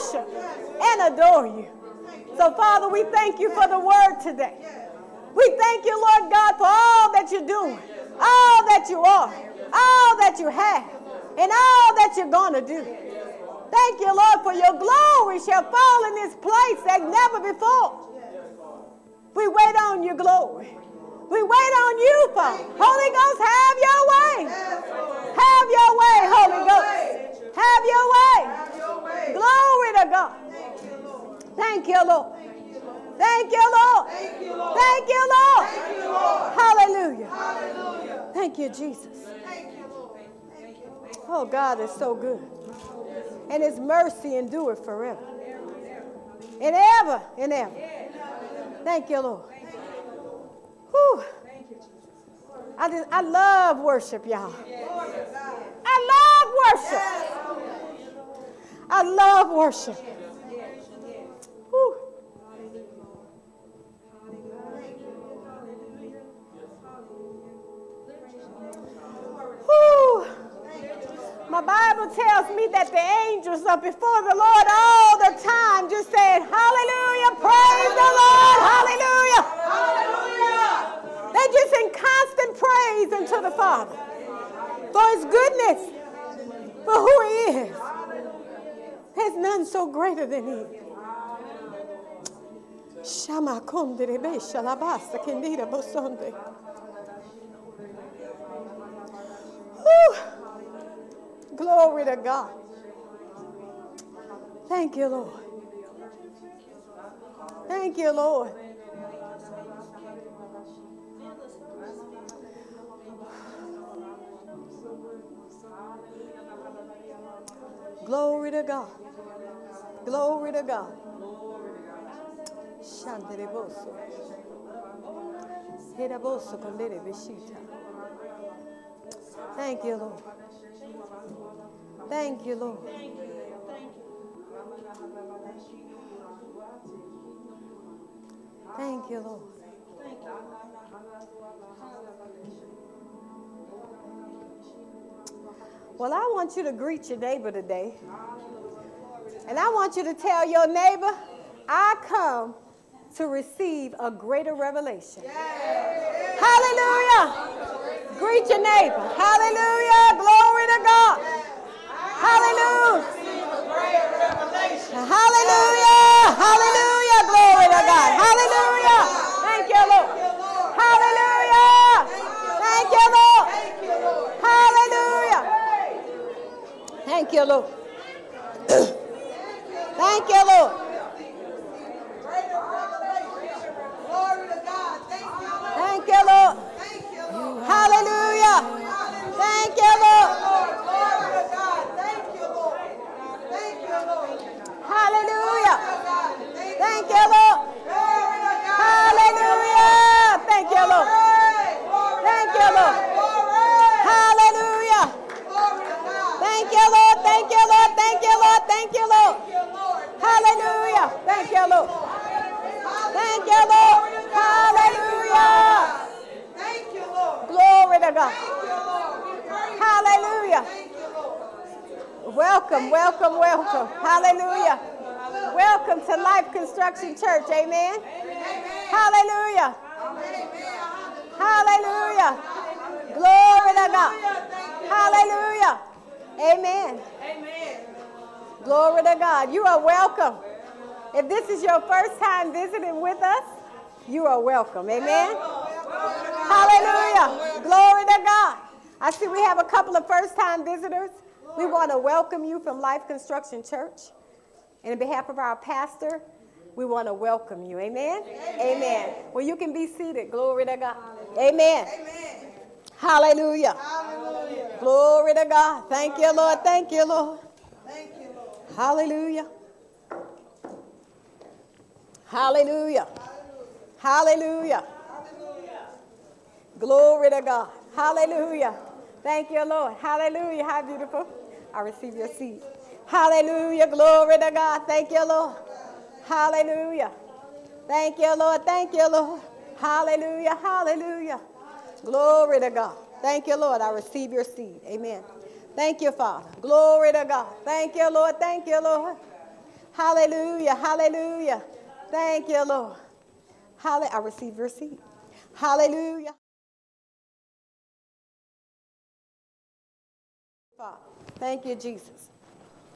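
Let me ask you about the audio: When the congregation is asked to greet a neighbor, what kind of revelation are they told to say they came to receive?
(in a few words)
A greater revelation.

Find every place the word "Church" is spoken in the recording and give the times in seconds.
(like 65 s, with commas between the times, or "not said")
227 s, 253 s.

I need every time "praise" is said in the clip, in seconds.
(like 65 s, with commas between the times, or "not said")
77 s, 82 s.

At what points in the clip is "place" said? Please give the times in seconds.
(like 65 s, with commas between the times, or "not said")
16 s.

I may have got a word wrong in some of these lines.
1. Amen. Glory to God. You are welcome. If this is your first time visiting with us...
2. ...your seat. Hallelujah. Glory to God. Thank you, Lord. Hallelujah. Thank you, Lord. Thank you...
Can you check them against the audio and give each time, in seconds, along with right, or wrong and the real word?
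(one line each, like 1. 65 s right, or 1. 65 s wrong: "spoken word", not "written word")
1. 236 s right
2. 282 s right.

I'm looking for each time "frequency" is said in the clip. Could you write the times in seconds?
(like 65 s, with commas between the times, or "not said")
not said.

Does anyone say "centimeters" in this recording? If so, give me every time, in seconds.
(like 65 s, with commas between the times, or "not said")
not said.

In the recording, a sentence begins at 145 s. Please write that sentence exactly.
Well, I want you to greet your neighbor today.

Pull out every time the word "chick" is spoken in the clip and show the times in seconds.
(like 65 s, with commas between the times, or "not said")
not said.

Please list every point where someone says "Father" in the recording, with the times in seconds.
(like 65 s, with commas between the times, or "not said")
2 s, 22 s, 83 s, 296 s, 310 s.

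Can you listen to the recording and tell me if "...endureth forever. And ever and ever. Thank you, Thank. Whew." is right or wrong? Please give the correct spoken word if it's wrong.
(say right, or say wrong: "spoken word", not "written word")
wrong: "Lord", not "Thank".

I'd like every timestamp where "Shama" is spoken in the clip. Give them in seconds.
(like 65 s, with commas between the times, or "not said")
93 s.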